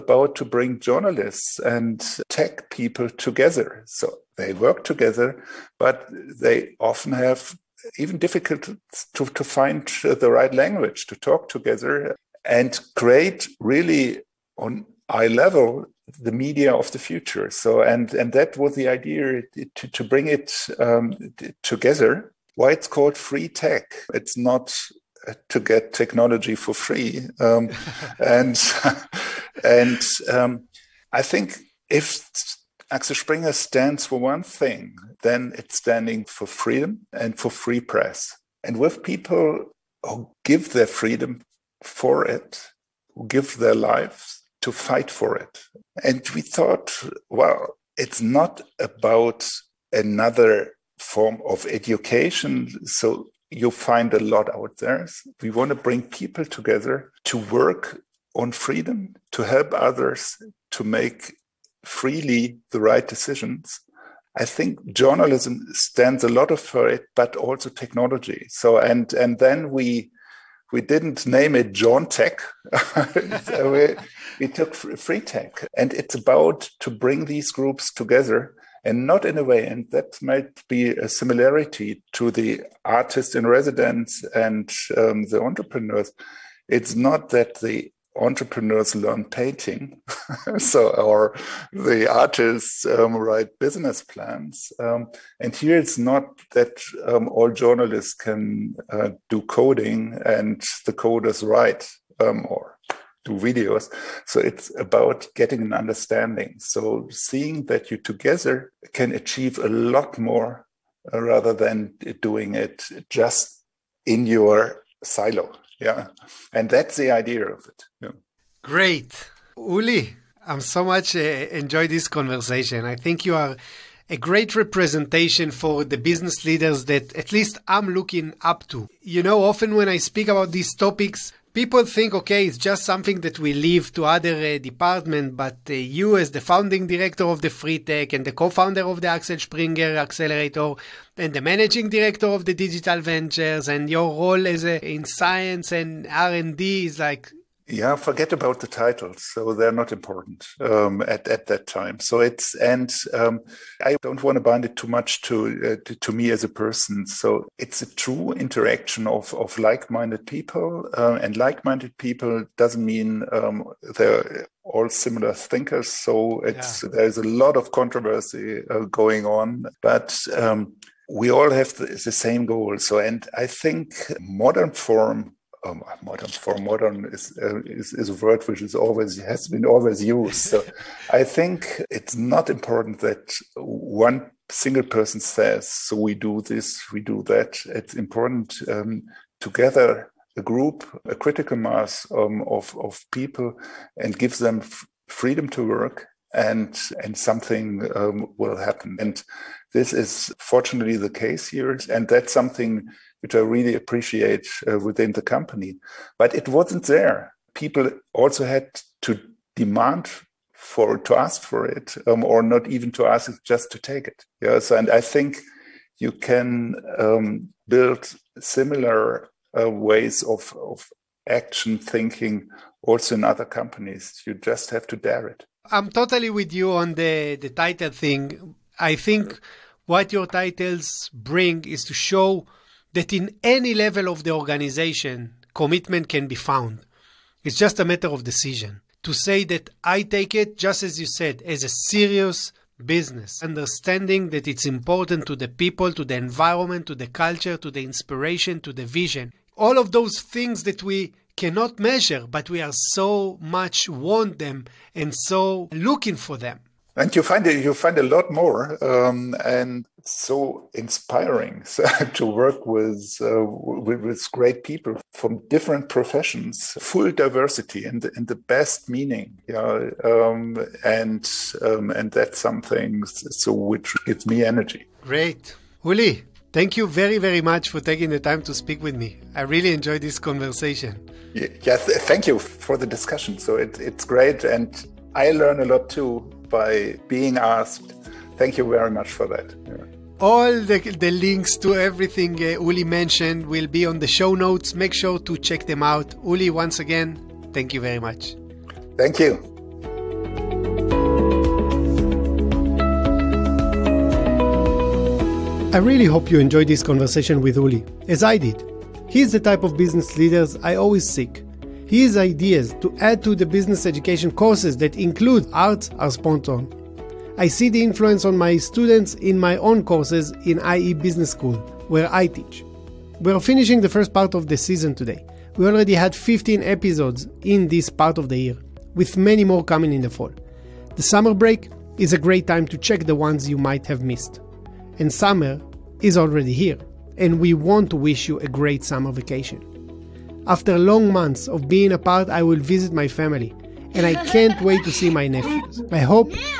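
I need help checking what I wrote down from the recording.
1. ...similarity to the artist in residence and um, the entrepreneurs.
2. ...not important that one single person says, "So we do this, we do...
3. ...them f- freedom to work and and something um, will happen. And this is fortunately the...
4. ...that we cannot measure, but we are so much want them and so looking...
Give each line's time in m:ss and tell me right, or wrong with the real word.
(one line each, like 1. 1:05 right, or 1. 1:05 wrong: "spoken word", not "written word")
1. 1:21 right
2. 3:02 right
3. 3:14 right
4. 4:10 right.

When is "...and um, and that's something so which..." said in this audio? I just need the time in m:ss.
4:30.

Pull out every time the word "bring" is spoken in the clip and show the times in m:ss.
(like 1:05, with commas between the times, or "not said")
0:00, 0:20, 0:55, 1:16, 3:51.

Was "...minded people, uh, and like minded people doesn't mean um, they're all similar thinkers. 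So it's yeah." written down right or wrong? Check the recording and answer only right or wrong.
right.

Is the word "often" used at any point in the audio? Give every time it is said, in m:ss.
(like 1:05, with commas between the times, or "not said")
0:06, 2:09.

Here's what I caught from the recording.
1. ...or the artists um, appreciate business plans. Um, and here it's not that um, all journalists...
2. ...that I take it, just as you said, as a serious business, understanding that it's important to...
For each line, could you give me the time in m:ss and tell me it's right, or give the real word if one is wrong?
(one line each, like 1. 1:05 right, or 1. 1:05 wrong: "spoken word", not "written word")
1. 1:30 wrong: "write", not "appreciate"
2. 3:59 right.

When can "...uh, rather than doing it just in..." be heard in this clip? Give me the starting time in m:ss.
1:51.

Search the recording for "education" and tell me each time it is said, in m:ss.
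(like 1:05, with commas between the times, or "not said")
0:51, 5:13.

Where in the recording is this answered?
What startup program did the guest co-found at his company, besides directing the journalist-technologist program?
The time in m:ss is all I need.
2:19.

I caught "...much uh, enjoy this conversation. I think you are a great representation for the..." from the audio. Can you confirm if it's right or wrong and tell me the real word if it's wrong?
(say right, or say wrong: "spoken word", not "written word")
right.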